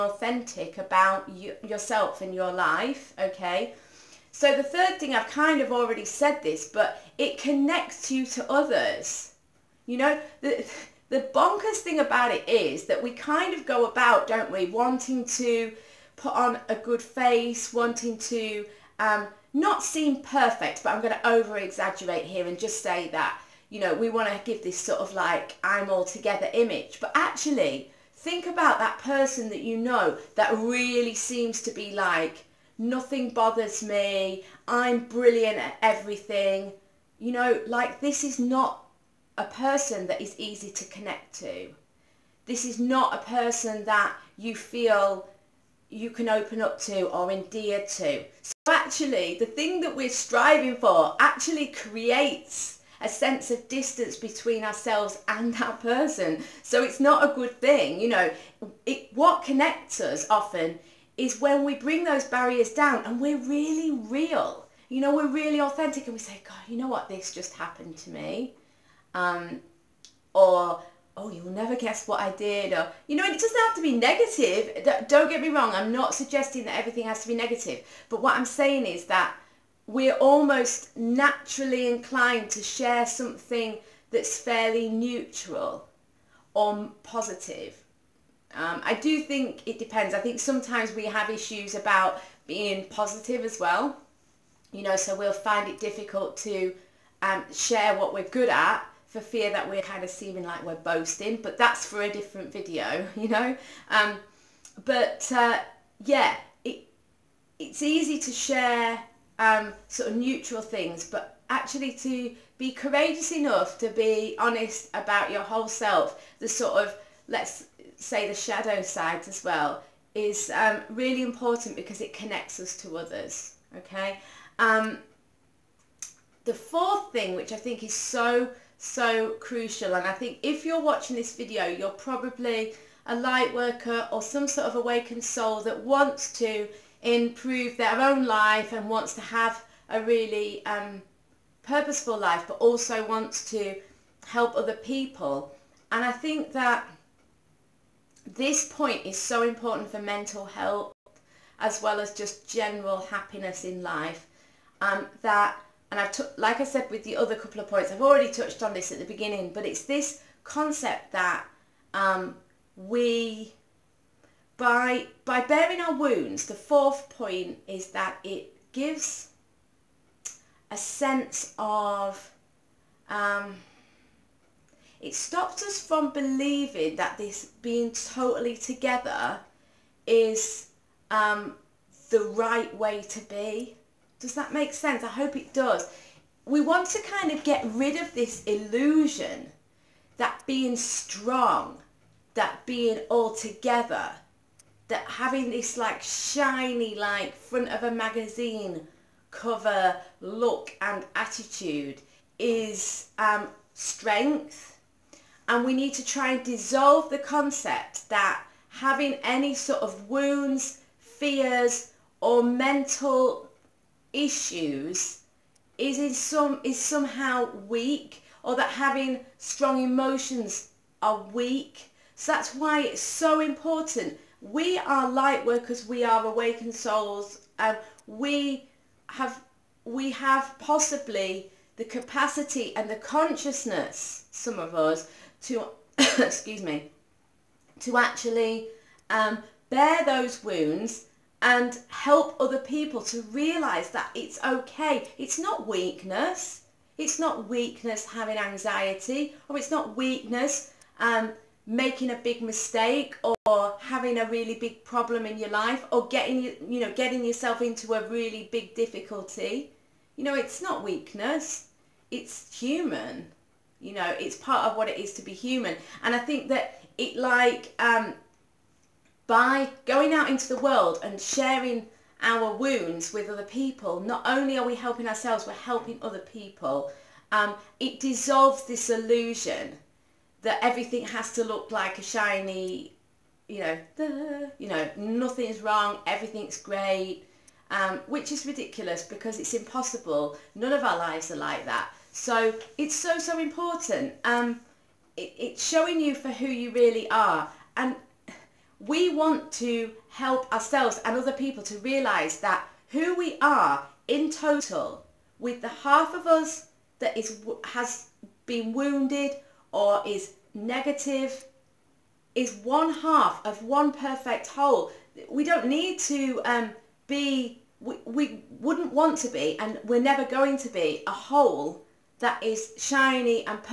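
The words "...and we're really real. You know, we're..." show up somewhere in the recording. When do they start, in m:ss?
1:03.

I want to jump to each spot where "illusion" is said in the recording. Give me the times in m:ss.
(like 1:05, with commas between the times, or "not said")
3:08, 4:38.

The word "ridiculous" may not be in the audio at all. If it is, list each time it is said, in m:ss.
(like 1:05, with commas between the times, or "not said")
4:48.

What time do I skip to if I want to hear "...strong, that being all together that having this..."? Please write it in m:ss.
3:10.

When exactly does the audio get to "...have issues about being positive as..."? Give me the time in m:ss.
1:31.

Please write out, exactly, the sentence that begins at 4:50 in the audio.
None of our lives are like that.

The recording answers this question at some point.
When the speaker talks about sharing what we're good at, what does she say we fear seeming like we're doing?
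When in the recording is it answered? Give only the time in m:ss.
1:40.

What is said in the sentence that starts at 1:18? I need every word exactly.
But what I'm saying is that we're almost naturally inclined to share something that's fairly neutral or positive.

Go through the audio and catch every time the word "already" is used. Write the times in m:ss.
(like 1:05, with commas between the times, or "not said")
0:05, 2:38.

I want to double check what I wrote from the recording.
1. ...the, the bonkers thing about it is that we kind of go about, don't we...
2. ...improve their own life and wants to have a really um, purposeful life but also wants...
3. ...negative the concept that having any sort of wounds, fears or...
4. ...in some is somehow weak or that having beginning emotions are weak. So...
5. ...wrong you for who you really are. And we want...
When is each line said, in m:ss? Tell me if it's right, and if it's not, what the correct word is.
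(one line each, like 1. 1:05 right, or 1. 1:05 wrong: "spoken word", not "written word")
1. 0:10 right
2. 2:17 right
3. 3:26 wrong: "dissolve", not "negative"
4. 3:35 wrong: "strong", not "beginning"
5. 4:55 wrong: "showing", not "wrong".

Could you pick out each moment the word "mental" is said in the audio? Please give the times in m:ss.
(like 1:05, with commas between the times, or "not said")
2:29, 3:32.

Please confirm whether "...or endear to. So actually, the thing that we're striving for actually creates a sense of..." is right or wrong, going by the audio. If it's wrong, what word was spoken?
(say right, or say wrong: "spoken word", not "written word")
right.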